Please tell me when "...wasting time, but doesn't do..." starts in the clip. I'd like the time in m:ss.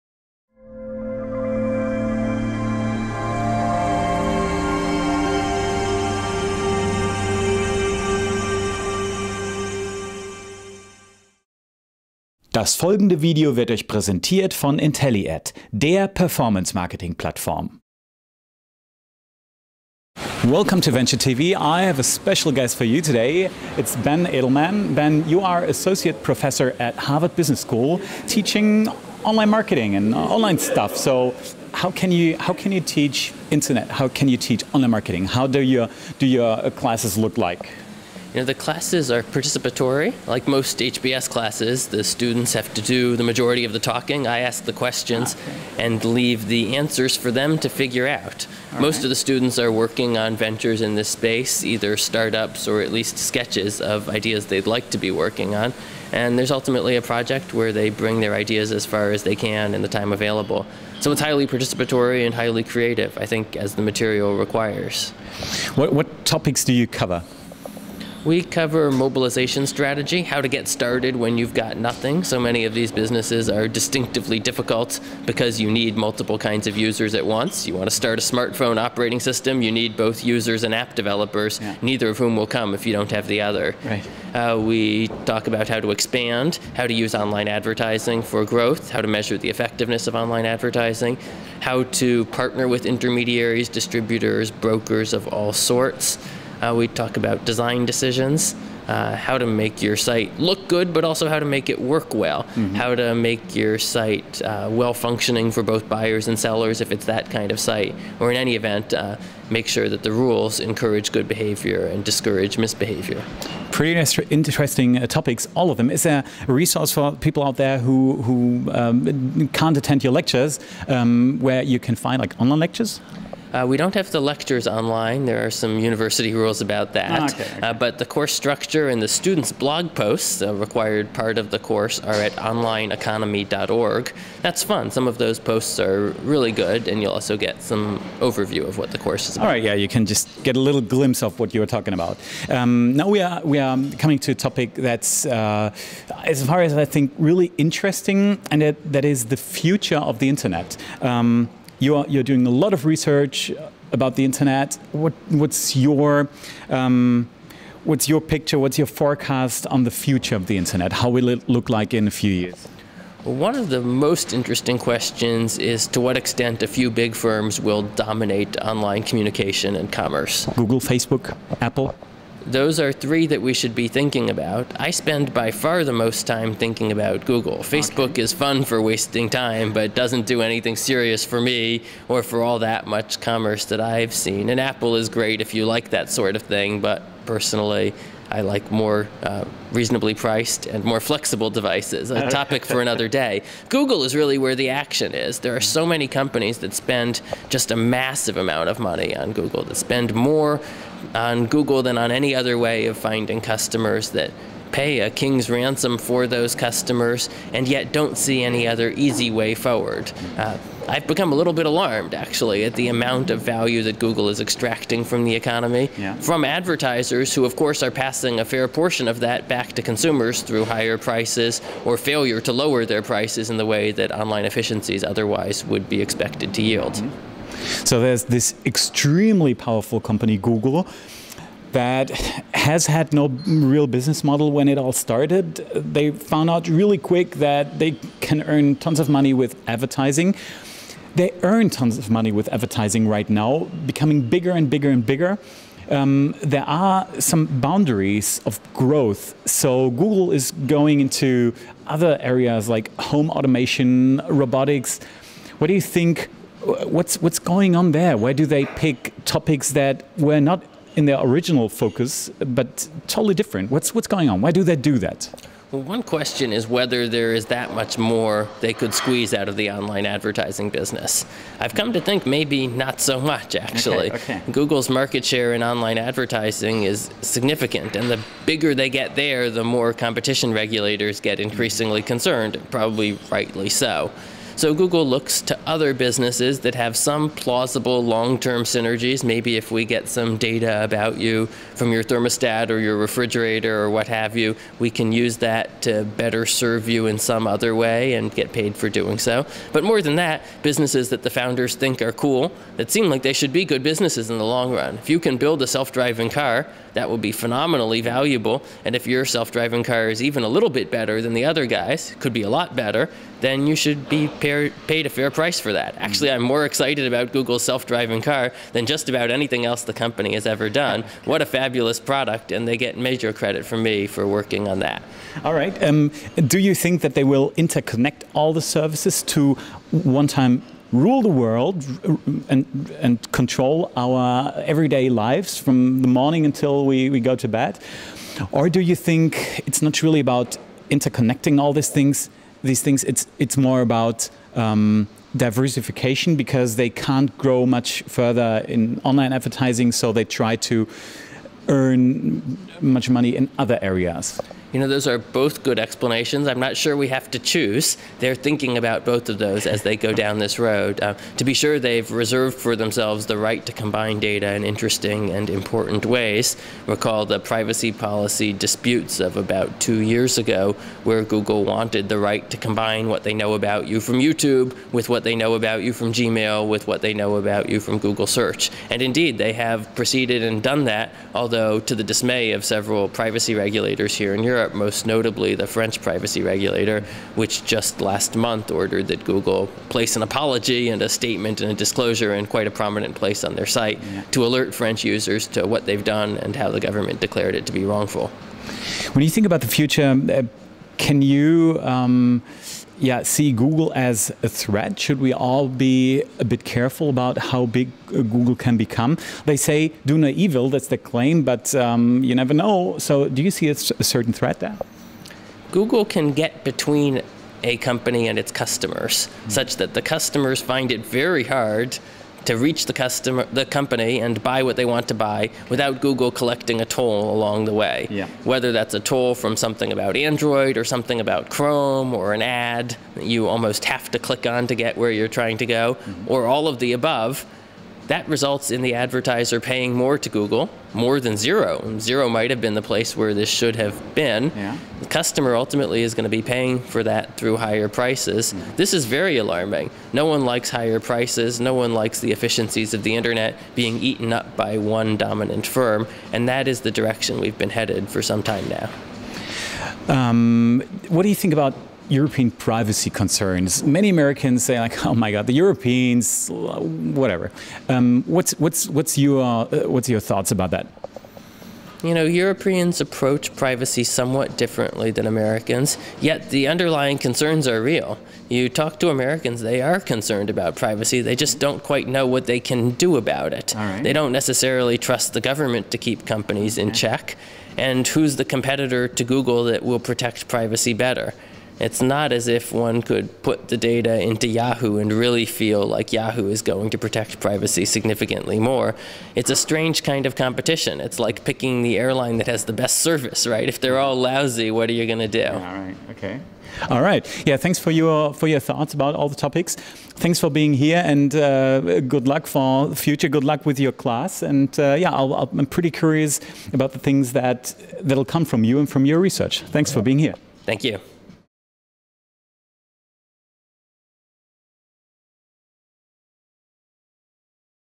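2:58.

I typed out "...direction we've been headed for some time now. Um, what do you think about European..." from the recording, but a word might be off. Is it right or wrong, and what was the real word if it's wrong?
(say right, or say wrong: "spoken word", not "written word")
right.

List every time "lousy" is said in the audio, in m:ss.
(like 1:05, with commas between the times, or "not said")
8:24.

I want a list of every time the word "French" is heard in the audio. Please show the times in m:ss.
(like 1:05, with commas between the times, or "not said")
6:25, 6:34.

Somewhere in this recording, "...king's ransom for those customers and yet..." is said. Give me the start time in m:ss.
3:25.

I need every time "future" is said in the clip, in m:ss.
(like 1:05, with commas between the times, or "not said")
2:29, 2:39, 6:39, 8:32.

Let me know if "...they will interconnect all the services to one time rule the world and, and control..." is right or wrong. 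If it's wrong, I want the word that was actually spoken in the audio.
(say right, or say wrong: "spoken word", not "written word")
right.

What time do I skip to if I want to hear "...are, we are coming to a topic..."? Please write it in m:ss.
2:23.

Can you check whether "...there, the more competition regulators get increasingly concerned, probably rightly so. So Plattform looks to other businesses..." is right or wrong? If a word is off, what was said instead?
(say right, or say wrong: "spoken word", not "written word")
wrong: "Google", not "Plattform".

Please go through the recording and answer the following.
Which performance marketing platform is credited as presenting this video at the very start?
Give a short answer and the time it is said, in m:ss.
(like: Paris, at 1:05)
IntelliAd, at 0:14.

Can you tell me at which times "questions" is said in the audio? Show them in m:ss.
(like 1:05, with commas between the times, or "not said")
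0:44, 2:44, 4:26.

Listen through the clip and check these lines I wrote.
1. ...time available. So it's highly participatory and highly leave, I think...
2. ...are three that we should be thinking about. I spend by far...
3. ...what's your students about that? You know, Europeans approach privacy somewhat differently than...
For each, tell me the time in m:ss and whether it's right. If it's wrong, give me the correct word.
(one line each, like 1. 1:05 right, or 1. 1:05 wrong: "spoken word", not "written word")
1. 0:59 wrong: "creative", not "leave"
2. 2:52 right
3. 7:49 wrong: "thoughts", not "students".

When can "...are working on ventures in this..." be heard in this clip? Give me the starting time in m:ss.
0:49.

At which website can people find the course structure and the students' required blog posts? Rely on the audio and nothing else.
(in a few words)
onlineeconomy.org.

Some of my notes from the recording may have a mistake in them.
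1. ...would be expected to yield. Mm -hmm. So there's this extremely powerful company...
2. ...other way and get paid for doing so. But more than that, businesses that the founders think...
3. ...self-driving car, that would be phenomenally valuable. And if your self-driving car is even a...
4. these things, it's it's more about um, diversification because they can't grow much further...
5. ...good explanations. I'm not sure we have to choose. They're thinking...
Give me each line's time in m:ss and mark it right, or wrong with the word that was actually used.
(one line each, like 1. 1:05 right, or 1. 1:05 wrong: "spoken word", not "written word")
1. 3:45 right
2. 4:57 right
3. 5:05 right
4. 5:42 right
5. 5:55 right.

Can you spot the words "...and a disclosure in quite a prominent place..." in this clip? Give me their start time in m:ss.
6:31.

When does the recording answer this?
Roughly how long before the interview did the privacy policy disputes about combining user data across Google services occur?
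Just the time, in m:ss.
6:09.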